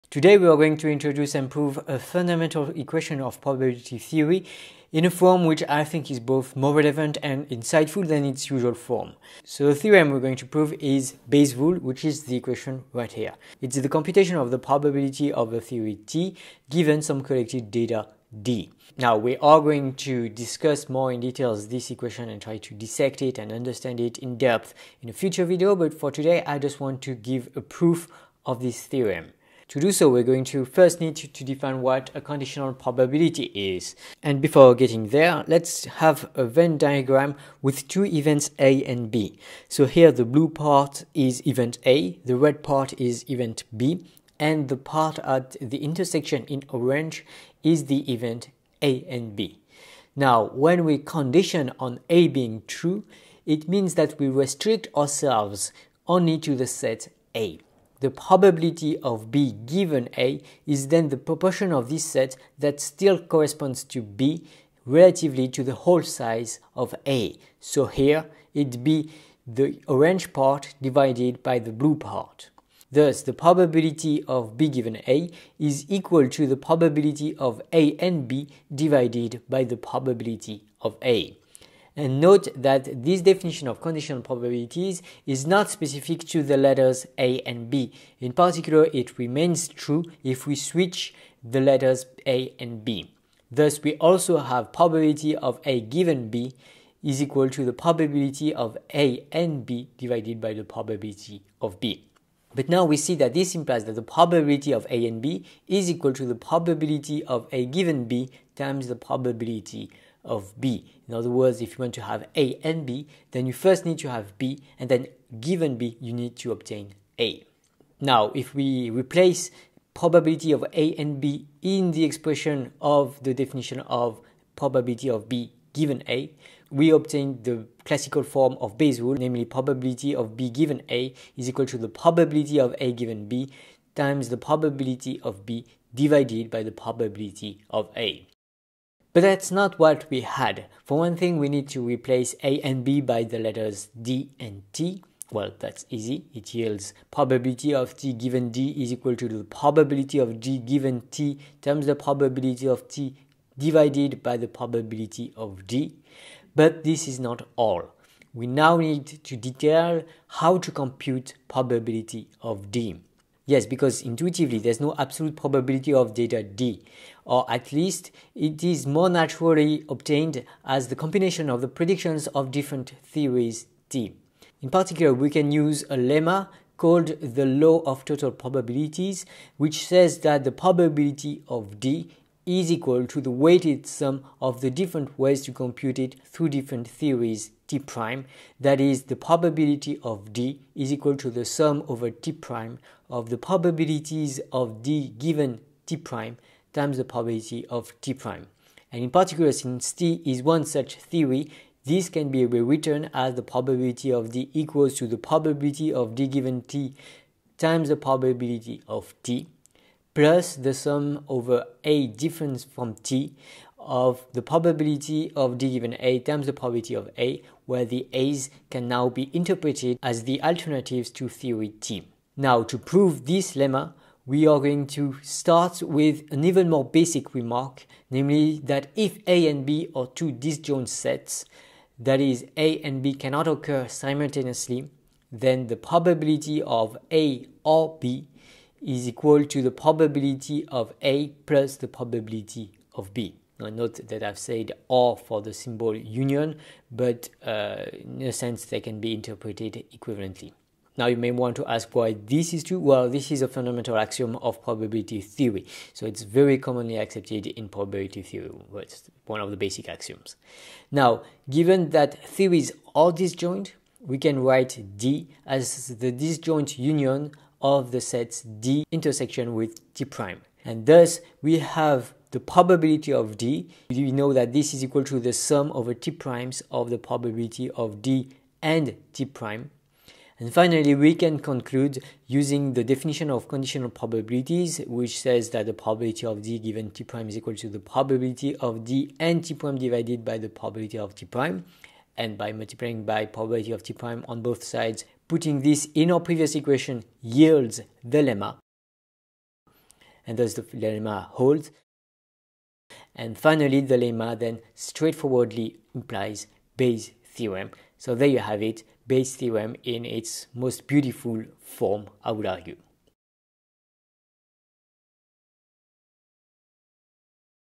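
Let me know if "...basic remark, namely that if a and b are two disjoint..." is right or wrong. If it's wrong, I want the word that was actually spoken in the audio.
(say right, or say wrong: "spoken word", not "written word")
right.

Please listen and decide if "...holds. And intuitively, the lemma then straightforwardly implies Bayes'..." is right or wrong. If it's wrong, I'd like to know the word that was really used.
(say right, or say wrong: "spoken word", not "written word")
wrong: "finally", not "intuitively".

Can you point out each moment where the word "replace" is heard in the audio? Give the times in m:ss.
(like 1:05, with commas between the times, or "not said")
1:58, 2:21.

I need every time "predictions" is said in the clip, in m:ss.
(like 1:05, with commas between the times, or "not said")
2:51.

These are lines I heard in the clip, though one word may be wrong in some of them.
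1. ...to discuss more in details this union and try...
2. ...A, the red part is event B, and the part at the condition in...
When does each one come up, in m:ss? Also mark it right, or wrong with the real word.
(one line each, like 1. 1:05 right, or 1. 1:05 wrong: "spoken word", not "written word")
1. 0:19 wrong: "equation", not "union"
2. 0:41 wrong: "intersection", not "condition".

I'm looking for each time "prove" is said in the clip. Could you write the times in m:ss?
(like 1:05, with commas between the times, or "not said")
0:01, 0:10, 3:42.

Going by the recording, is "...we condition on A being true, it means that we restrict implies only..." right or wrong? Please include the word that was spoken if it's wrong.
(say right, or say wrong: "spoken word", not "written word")
wrong: "ourselves", not "implies".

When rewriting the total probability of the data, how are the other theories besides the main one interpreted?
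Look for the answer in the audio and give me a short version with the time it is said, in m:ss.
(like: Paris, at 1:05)
Alternatives to theory T, at 3:40.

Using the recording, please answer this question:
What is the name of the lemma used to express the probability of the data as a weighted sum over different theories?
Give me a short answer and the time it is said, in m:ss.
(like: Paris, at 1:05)
Law of total probabilities, at 2:57.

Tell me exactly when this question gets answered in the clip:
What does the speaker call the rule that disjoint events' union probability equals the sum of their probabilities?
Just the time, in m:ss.
4:13.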